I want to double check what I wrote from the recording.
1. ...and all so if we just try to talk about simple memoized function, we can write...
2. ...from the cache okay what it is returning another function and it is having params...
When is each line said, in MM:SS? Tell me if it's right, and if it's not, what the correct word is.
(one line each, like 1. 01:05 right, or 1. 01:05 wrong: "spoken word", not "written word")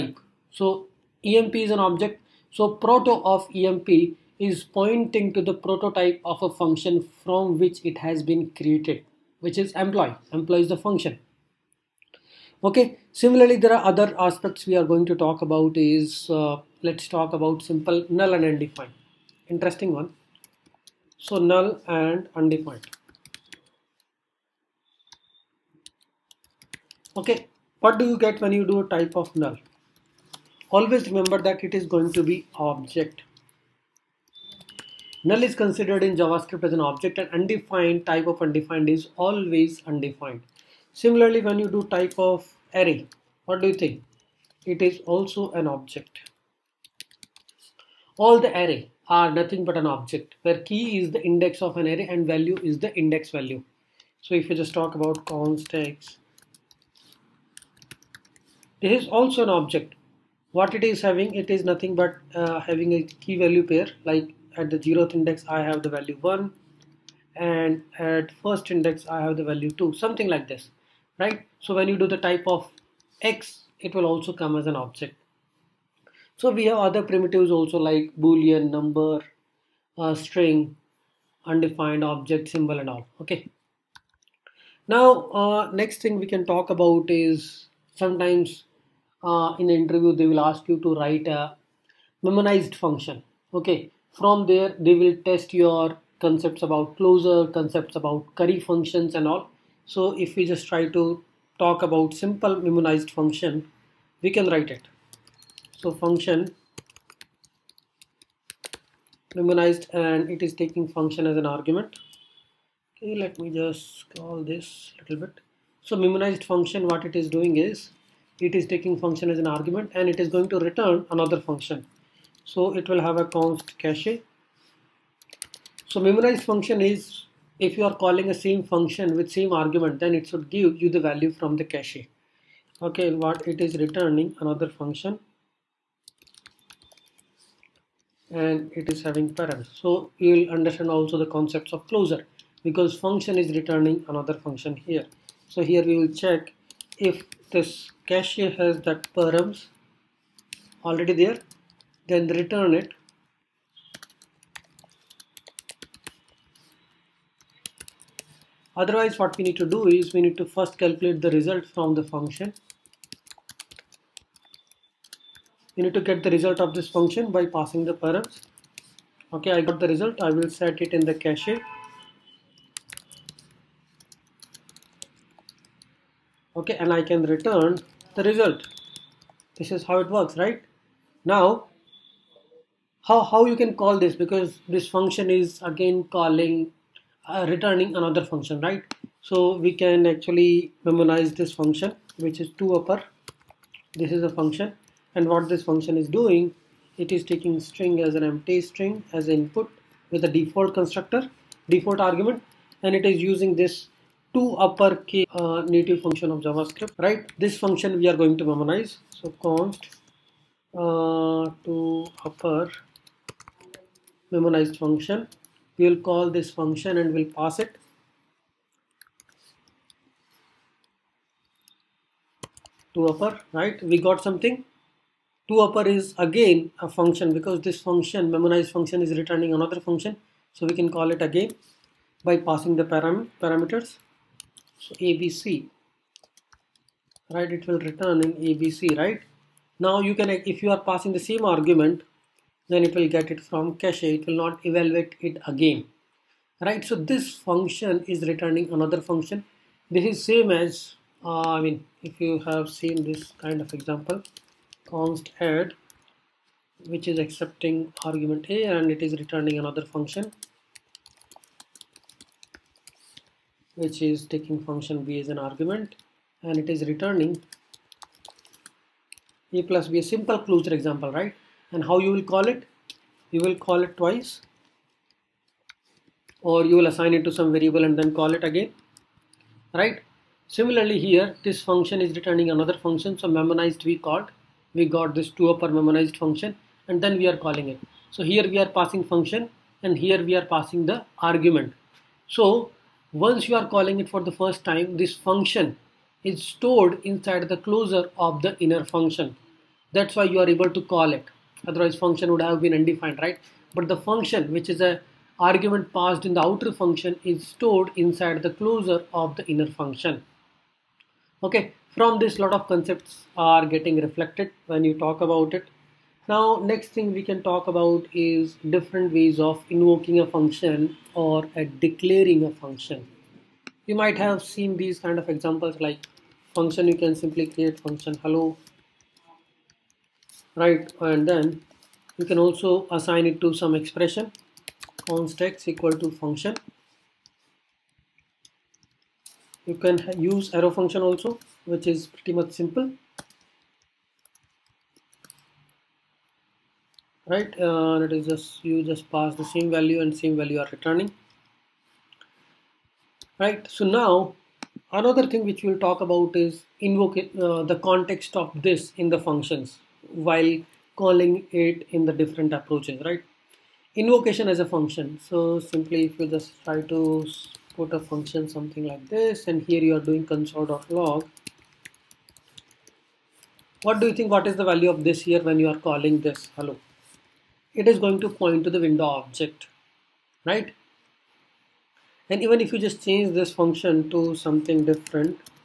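1. 01:39 right
2. 02:11 right.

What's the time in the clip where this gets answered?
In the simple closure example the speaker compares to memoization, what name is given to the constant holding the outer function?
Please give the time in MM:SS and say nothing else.
04:15.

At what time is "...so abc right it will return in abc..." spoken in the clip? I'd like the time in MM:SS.
03:54.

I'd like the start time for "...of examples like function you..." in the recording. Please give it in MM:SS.
05:25.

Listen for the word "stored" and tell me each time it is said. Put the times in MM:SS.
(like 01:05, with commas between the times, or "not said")
04:56, 05:07.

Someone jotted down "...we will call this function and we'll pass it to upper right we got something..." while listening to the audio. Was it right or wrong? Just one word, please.
right.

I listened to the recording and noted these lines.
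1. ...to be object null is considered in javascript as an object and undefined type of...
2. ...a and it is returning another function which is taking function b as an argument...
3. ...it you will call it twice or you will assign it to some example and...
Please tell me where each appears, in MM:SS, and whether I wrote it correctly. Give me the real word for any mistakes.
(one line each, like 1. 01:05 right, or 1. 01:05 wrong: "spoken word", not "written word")
1. 00:32 right
2. 04:18 right
3. 04:32 wrong: "variable", not "example".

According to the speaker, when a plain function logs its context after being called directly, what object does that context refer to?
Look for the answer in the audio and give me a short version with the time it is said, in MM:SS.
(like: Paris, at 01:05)
window object, at 06:18.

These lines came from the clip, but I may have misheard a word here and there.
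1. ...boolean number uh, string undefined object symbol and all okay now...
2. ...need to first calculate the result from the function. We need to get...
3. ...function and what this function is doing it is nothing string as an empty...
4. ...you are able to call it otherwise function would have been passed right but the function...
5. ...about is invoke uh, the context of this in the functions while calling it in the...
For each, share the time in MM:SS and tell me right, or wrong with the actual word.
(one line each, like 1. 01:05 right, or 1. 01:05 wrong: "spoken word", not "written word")
1. 01:18 right
2. 02:40 right
3. 03:14 wrong: "taking", not "nothing"
4. 05:00 wrong: "undefined", not "passed"
5. 05:56 right.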